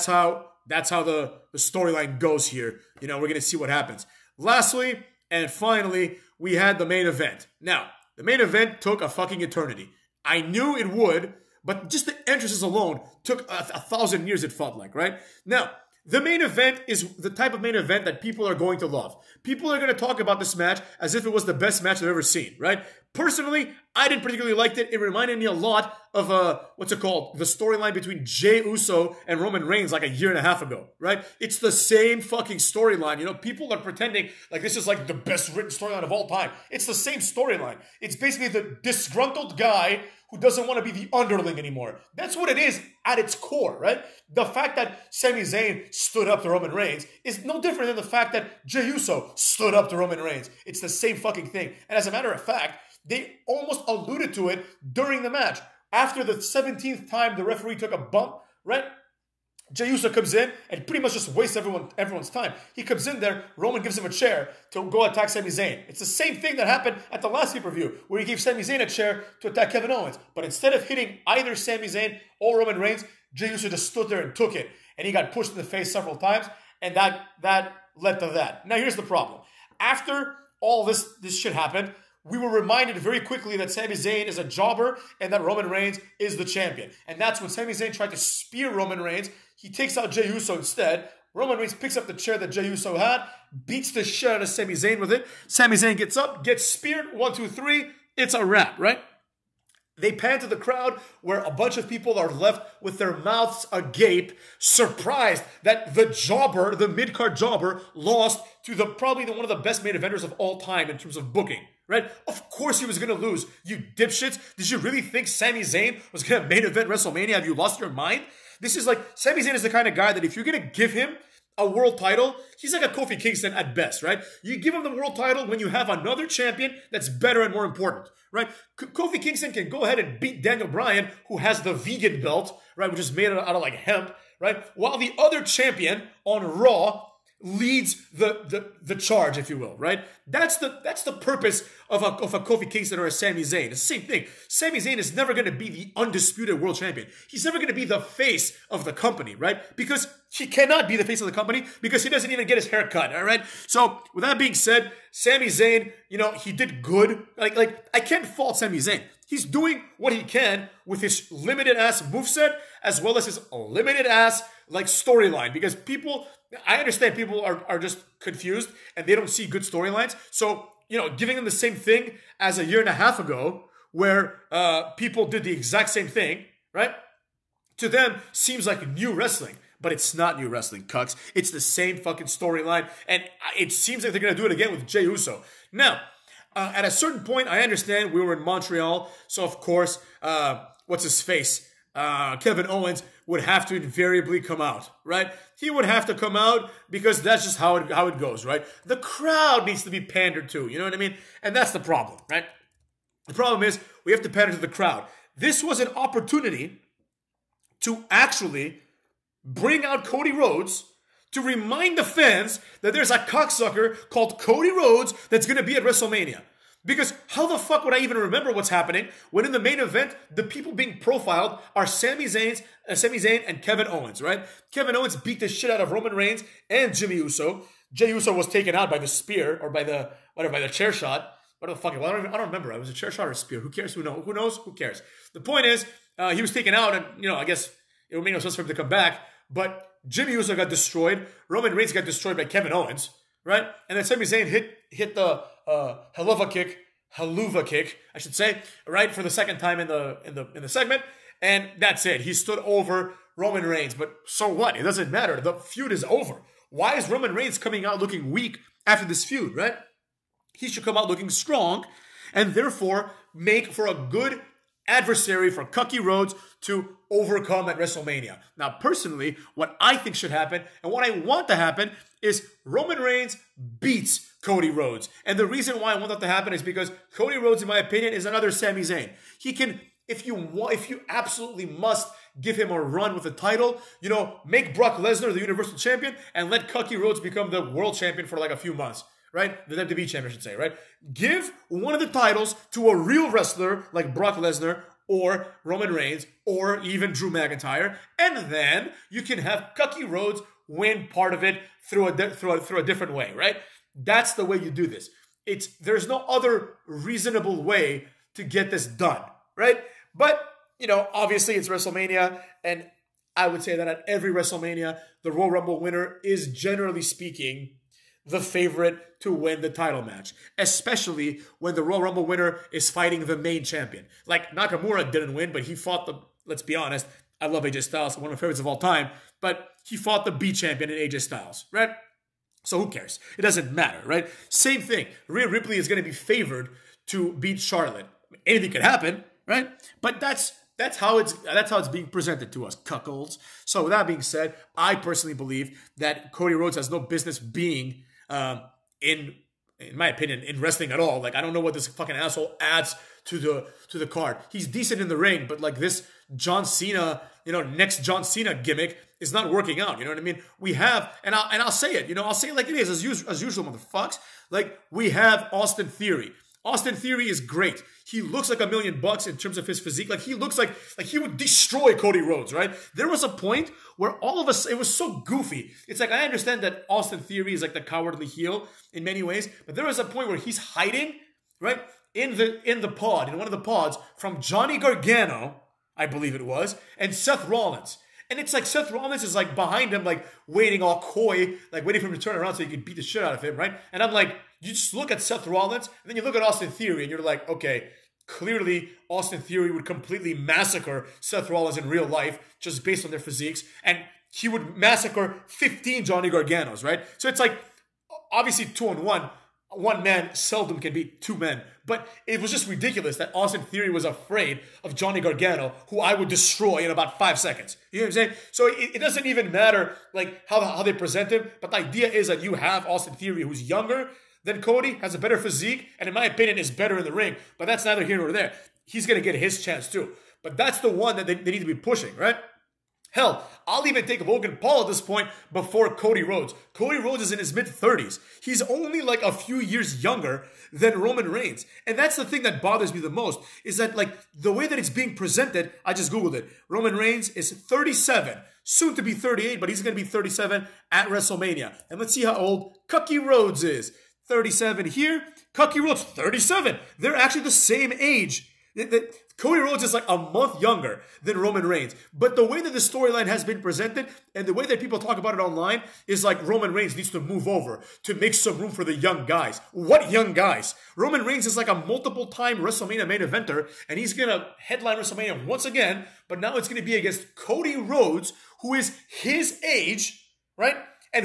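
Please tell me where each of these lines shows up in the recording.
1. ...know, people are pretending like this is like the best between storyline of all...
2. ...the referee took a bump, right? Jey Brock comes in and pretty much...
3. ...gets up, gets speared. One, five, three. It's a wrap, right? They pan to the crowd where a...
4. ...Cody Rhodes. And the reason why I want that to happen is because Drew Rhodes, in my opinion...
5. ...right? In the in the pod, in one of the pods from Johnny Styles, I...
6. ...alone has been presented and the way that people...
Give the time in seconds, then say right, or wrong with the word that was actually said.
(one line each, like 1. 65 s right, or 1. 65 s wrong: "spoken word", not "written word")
1. 33 s wrong: "written", not "between"
2. 57 s wrong: "Uso", not "Brock"
3. 95 s wrong: "two", not "five"
4. 274 s wrong: "Cody", not "Drew"
5. 381 s wrong: "Gargano", not "Styles"
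6. 462 s wrong: "storyline", not "alone".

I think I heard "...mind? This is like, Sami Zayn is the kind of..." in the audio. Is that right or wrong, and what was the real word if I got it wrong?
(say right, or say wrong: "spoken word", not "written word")
right.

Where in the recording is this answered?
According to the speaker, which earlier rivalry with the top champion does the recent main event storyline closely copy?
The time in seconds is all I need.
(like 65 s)
28 s.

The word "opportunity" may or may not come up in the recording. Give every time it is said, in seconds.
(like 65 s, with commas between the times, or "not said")
205 s.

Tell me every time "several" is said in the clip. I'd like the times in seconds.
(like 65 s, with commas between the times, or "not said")
75 s.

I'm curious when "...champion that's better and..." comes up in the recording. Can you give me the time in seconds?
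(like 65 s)
126 s.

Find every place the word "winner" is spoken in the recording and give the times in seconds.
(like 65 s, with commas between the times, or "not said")
315 s, 322 s.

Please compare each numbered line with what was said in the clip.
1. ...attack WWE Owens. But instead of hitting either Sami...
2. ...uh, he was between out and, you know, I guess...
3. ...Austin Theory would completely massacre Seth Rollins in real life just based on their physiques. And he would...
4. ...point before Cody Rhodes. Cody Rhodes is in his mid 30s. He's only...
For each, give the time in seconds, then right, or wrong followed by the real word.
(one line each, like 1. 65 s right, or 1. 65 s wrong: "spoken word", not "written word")
1. 69 s wrong: "Kevin", not "WWE"
2. 236 s wrong: "taken", not "between"
3. 399 s right
4. 434 s right.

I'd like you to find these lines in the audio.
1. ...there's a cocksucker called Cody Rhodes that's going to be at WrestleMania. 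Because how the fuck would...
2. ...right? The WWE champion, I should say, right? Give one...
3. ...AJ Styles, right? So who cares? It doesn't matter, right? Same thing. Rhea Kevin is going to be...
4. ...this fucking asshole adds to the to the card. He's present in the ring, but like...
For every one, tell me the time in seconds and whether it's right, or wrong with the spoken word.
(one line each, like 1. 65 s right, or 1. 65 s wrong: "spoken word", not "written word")
1. 212 s right
2. 289 s right
3. 330 s wrong: "Ripley", not "Kevin"
4. 351 s wrong: "decent", not "present".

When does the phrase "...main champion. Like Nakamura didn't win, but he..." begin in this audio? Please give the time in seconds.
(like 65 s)
323 s.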